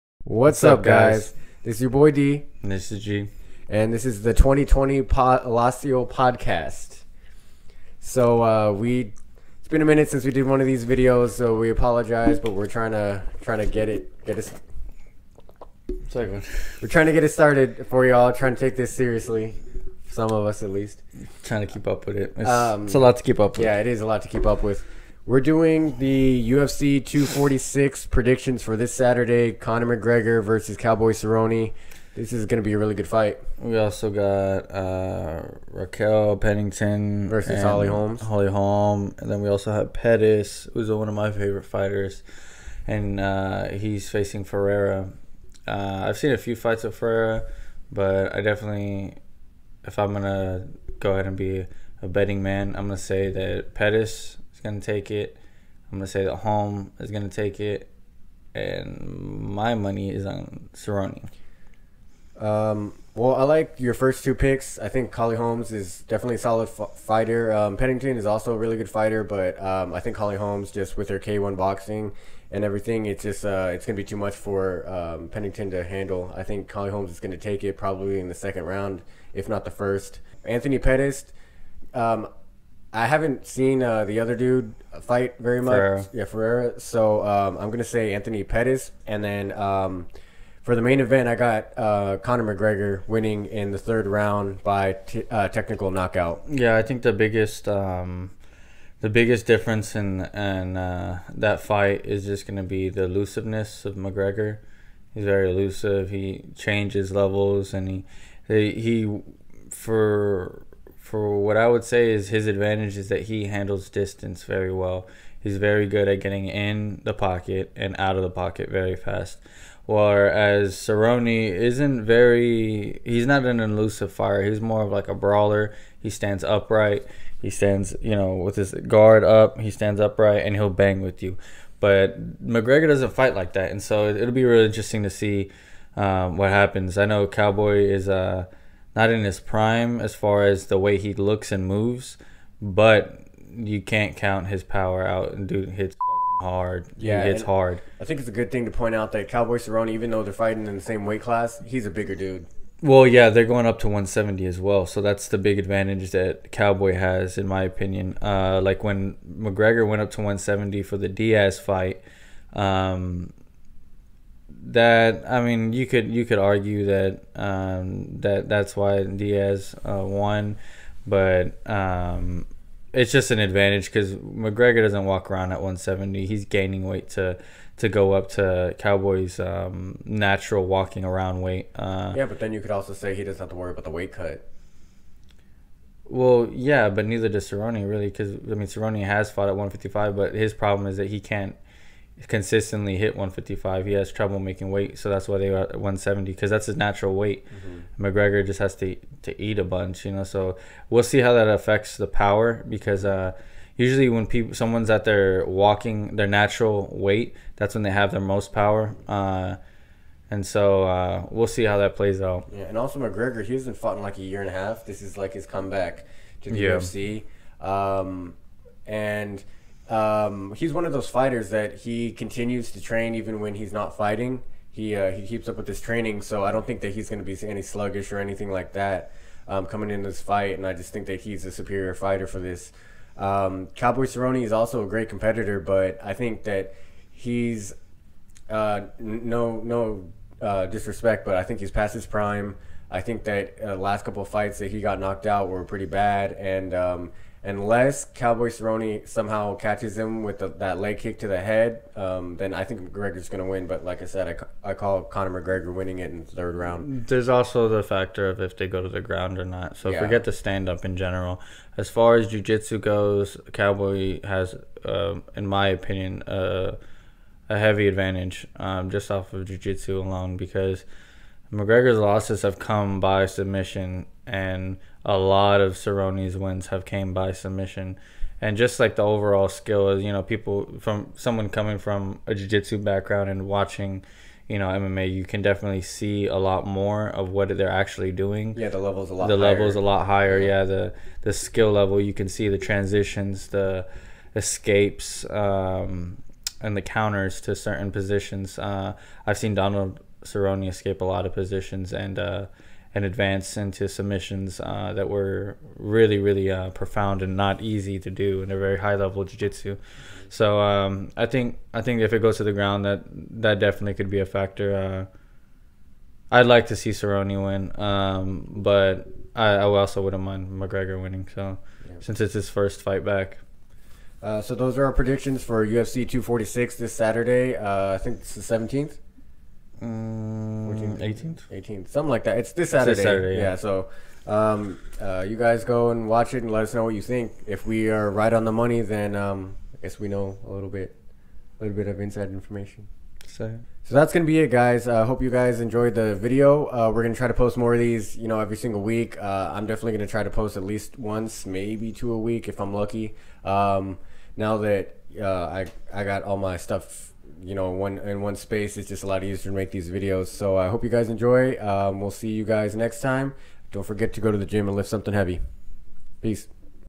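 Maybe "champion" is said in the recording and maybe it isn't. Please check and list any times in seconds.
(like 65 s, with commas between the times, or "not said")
not said.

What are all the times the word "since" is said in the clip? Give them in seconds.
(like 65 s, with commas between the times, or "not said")
10 s, 321 s.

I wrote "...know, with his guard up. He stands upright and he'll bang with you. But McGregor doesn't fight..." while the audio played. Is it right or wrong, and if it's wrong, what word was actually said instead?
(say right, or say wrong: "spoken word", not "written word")
right.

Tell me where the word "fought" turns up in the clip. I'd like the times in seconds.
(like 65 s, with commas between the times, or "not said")
189 s, 213 s.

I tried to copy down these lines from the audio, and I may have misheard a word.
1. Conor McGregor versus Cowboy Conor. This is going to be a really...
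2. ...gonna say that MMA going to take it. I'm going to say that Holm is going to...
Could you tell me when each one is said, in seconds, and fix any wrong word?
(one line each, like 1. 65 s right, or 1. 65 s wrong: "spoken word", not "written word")
1. 29 s wrong: "Cerrone", not "Conor"
2. 52 s wrong: "Pettis", not "MMA".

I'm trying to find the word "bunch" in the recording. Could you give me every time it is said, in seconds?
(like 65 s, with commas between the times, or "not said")
199 s.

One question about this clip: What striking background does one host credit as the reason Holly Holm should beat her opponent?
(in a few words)
K1 boxing.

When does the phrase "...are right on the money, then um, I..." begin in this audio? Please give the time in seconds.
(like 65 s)
337 s.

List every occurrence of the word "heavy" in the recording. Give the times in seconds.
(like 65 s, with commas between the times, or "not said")
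267 s, 365 s.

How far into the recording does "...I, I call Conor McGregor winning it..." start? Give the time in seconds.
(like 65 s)
254 s.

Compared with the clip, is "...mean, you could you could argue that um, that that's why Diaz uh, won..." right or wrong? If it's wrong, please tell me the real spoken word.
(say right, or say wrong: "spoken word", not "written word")
right.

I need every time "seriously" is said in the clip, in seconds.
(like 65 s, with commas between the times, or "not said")
18 s.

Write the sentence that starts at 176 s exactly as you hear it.
He's gaining weight to to go up to Cowboy's um, natural walking around weight.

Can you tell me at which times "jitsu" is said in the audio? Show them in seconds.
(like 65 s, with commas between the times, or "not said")
262 s, 269 s, 282 s, 309 s.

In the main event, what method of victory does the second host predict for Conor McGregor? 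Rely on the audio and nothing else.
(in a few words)
Technical knockout.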